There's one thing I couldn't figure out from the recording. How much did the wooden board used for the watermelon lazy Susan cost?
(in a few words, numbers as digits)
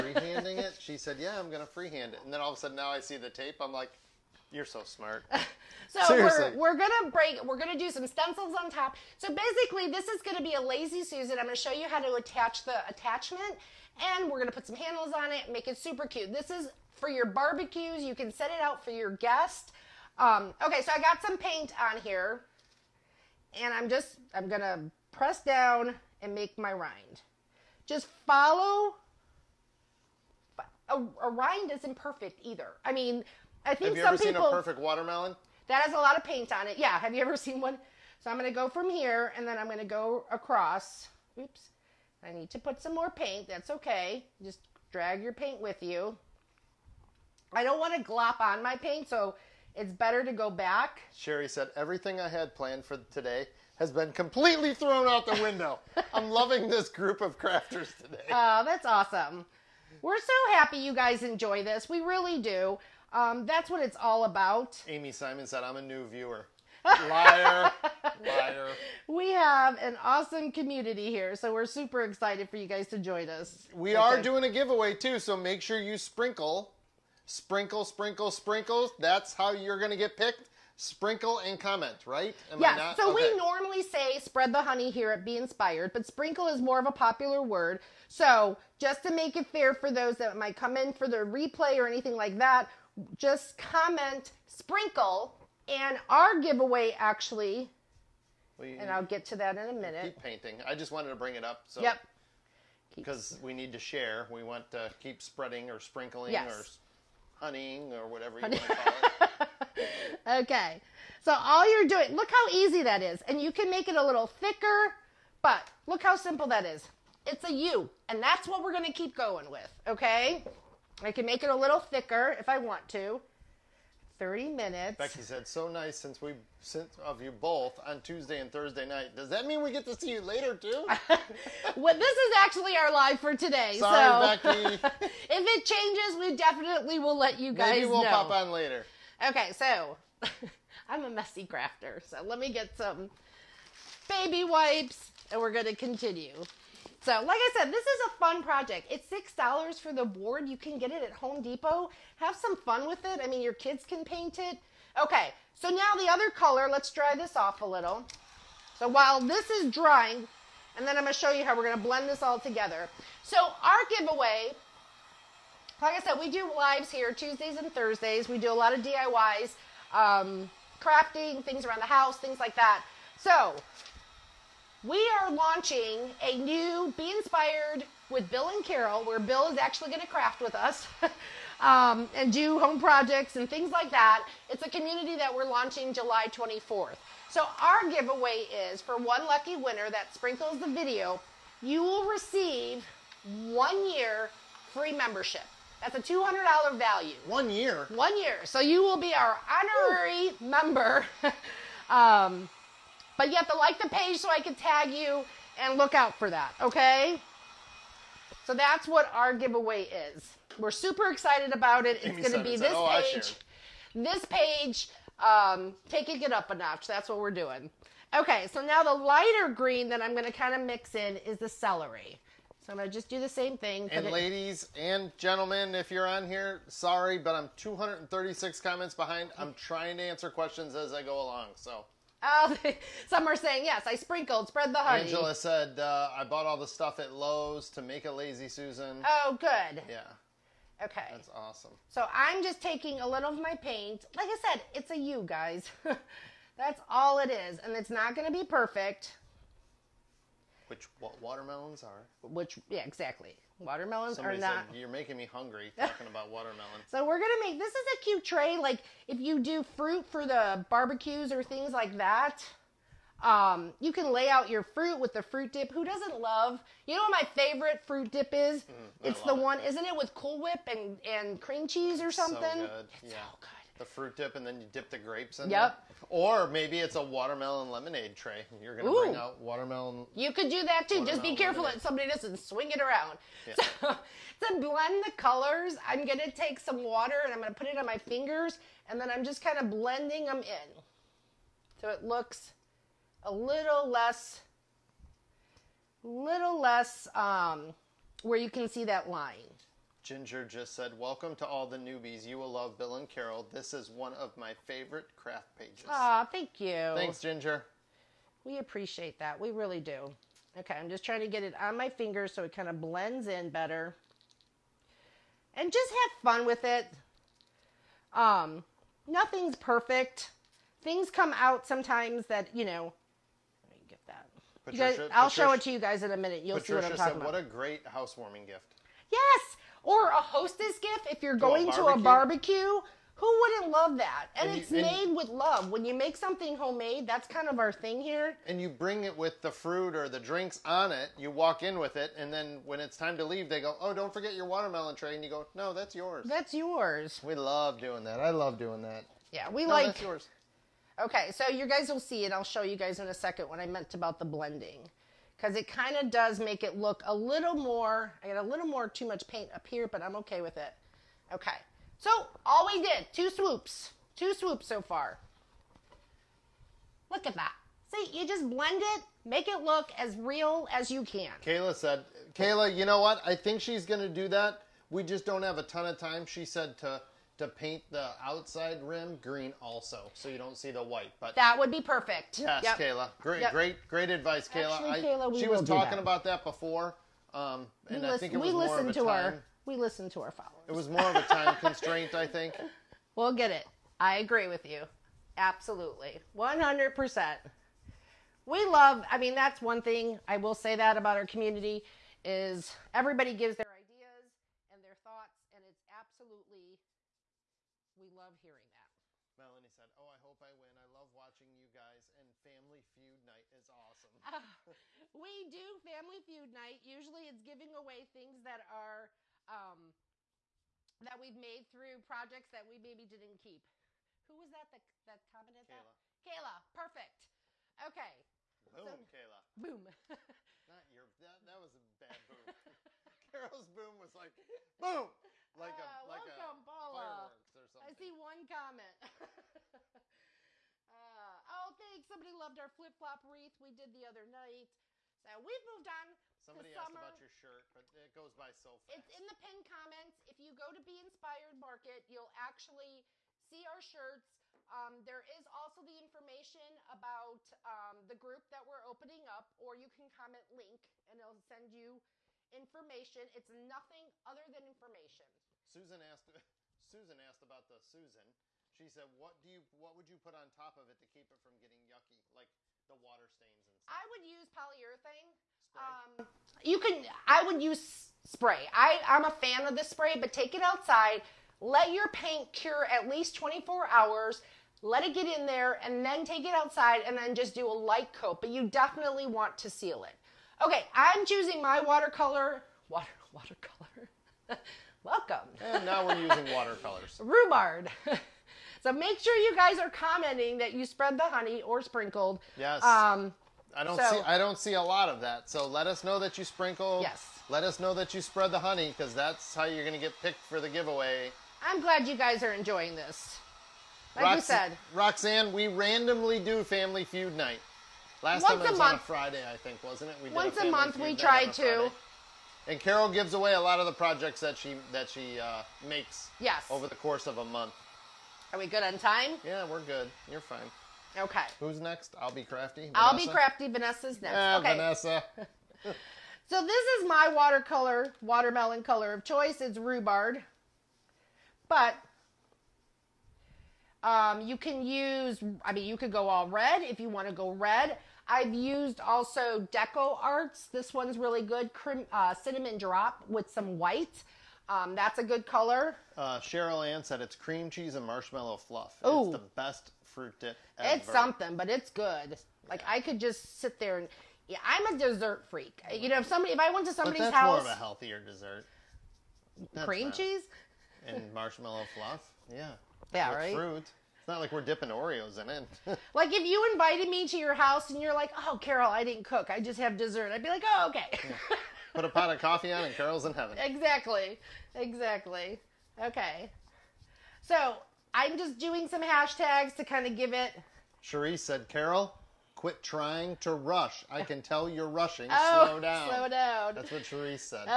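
$6.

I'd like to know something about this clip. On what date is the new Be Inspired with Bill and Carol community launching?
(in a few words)
July 24th.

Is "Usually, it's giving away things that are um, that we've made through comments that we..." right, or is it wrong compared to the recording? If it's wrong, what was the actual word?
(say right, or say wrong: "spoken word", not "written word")
wrong: "projects", not "comments".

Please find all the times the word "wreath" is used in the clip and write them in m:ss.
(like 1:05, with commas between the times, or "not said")
7:23.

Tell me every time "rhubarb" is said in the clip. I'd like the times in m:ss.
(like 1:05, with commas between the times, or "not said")
8:17, 8:59.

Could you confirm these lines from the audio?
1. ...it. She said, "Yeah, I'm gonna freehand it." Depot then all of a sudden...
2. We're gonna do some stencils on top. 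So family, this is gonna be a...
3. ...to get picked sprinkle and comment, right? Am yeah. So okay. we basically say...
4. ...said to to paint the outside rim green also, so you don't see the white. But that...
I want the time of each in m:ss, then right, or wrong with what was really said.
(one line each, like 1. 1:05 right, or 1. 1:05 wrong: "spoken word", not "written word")
1. 0:00 wrong: "And", not "Depot"
2. 0:07 wrong: "basically", not "family"
3. 1:19 wrong: "normally", not "basically"
4. 6:16 right.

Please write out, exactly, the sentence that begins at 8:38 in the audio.
Last once time it was a month, on a Friday, I think, wasn't it?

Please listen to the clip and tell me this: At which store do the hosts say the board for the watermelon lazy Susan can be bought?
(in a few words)
Home Depot.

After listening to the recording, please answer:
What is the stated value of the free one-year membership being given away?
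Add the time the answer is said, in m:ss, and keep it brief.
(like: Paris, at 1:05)
$200, at 3:16.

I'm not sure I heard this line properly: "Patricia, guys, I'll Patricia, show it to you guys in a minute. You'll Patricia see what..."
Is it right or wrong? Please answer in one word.
right.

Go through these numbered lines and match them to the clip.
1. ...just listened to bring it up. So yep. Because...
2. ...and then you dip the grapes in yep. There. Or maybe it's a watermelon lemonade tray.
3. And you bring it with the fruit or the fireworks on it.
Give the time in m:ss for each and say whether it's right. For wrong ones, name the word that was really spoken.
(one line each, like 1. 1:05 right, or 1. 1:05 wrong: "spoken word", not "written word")
1. 1:40 wrong: "wanted", not "listened"
2. 4:34 right
3. 5:38 wrong: "drinks", not "fireworks".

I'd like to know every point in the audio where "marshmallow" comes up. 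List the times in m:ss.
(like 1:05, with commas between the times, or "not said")
9:18, 9:31.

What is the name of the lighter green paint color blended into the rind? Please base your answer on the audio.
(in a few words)
celery.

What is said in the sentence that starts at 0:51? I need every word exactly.
Sherry said, Everything I had planned for today has been completely thrown out the window.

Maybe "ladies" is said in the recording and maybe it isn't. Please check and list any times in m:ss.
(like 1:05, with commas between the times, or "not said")
3:44.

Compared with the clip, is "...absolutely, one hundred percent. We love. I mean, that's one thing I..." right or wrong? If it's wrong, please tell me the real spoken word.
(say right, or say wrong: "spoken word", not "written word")
right.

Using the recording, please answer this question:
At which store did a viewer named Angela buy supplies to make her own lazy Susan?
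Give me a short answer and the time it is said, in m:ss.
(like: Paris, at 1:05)
Lowe's, at 3:57.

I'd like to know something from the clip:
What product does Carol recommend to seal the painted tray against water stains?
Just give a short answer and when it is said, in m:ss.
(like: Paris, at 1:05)
polyurethane, at 7:54.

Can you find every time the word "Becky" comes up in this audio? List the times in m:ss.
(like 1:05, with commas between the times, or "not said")
2:04, 2:14.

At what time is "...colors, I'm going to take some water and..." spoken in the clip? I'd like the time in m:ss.
4:45.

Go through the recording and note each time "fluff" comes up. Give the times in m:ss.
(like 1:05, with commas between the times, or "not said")
9:18, 9:31.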